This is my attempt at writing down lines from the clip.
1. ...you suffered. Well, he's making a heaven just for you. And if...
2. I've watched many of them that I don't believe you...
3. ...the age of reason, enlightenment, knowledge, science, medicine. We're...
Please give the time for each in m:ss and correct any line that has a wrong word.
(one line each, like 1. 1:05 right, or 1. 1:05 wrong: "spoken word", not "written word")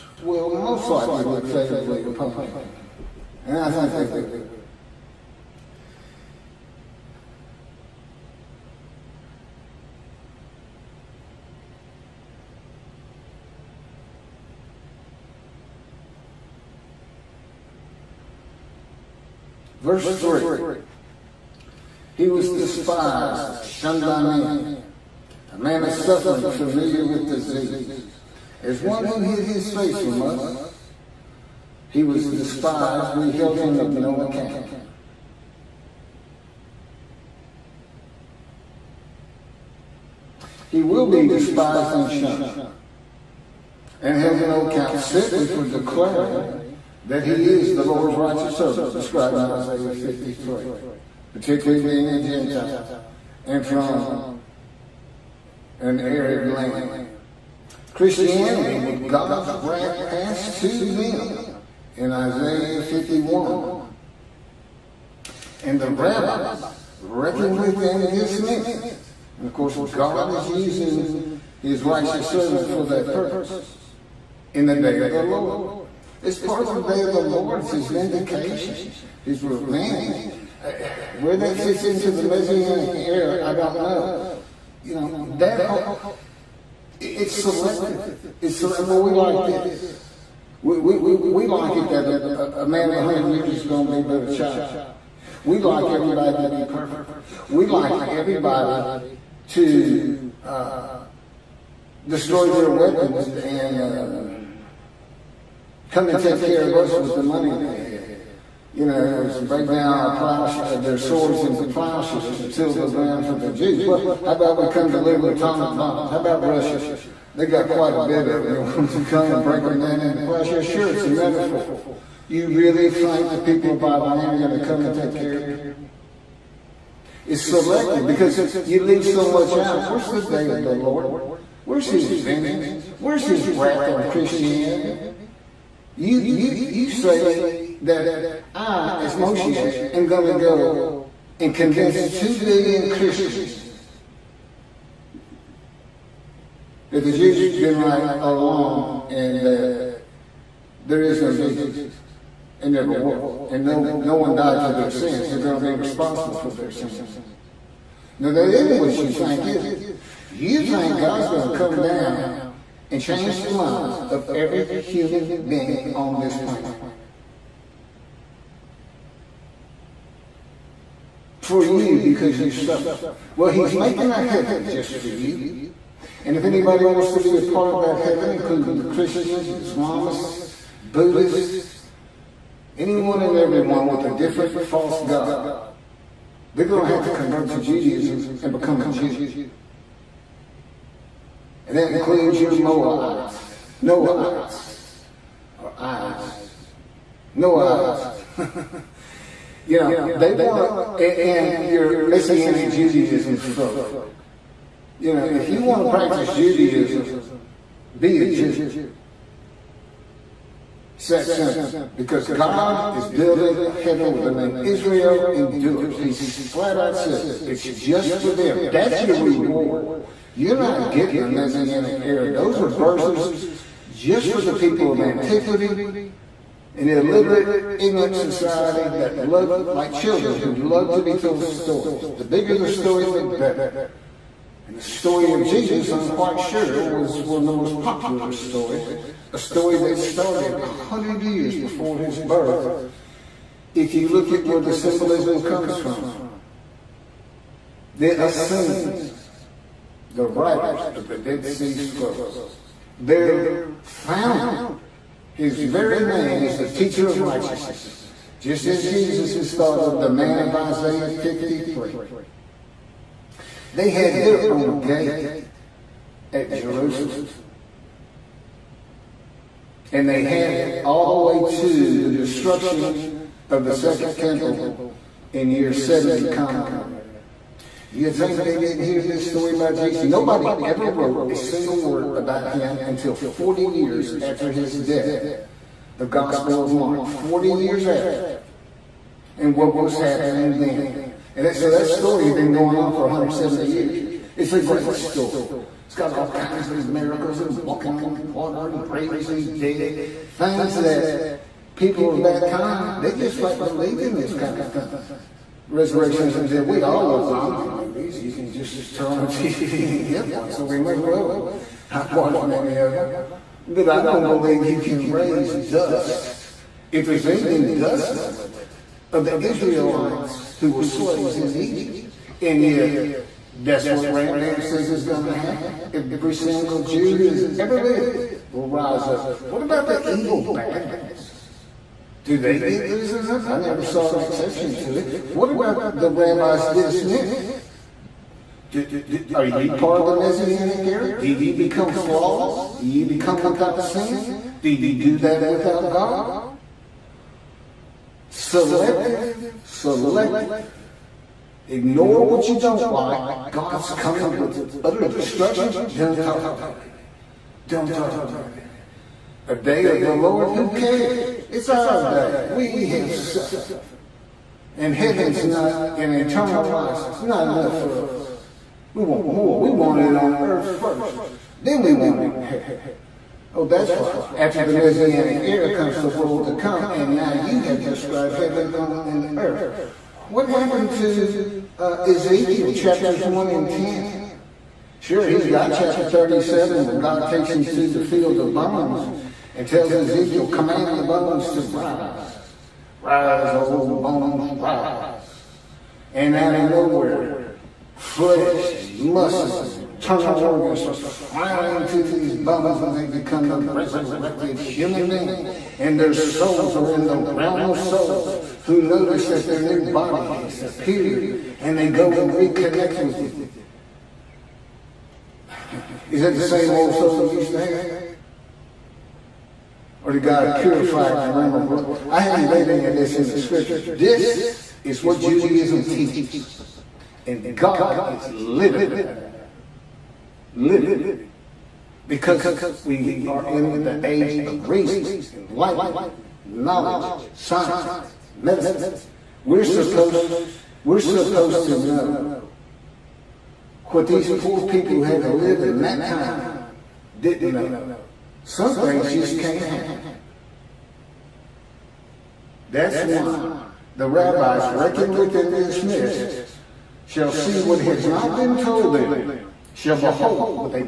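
1. 2:52 right
2. 5:11 right
3. 7:13 right.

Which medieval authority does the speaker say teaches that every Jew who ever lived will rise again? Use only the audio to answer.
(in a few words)
Rambam.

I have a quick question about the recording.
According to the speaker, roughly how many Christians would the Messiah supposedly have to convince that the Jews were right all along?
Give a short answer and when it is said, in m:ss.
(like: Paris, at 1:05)
2 billion, at 2:22.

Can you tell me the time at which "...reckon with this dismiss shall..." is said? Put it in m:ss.
7:34.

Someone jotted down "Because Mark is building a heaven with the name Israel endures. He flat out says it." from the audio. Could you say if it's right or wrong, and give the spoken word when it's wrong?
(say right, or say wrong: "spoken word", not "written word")
wrong: "God", not "Mark".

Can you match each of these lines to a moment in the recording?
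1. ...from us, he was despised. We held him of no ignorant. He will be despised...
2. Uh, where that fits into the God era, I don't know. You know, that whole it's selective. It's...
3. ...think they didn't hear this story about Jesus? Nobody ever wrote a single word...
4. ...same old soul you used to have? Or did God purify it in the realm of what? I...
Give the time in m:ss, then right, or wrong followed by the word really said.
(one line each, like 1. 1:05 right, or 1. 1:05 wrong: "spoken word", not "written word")
1. 0:29 wrong: "account", not "ignorant"
2. 1:20 wrong: "Messianic", not "God"
3. 4:38 right
4. 6:56 right.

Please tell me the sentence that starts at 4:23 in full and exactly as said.
They had their own gate at Jerusalem.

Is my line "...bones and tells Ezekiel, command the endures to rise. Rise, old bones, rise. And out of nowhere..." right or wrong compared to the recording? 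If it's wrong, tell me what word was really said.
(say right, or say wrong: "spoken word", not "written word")
wrong: "bones", not "endures".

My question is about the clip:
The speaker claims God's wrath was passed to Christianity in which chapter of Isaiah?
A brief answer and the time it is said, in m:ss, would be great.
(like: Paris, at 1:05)
Isaiah 51, at 1:02.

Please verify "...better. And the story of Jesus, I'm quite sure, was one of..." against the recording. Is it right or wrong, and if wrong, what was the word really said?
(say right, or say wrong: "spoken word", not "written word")
right.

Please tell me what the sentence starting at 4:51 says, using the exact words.
And so that story had been going on for 170 years.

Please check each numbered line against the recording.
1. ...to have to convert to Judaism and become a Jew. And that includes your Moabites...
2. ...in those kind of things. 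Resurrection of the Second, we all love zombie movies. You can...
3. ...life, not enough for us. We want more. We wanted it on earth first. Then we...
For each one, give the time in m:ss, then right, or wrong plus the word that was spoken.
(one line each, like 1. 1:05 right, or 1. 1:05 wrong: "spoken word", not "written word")
1. 3:06 right
2. 5:04 wrong: "Dead", not "Second"
3. 6:06 right.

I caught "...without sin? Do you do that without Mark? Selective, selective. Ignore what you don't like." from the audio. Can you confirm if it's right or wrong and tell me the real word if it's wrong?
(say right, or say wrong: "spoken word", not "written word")
wrong: "God", not "Mark".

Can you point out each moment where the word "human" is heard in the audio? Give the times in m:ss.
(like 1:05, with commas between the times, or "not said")
2:44, 6:44.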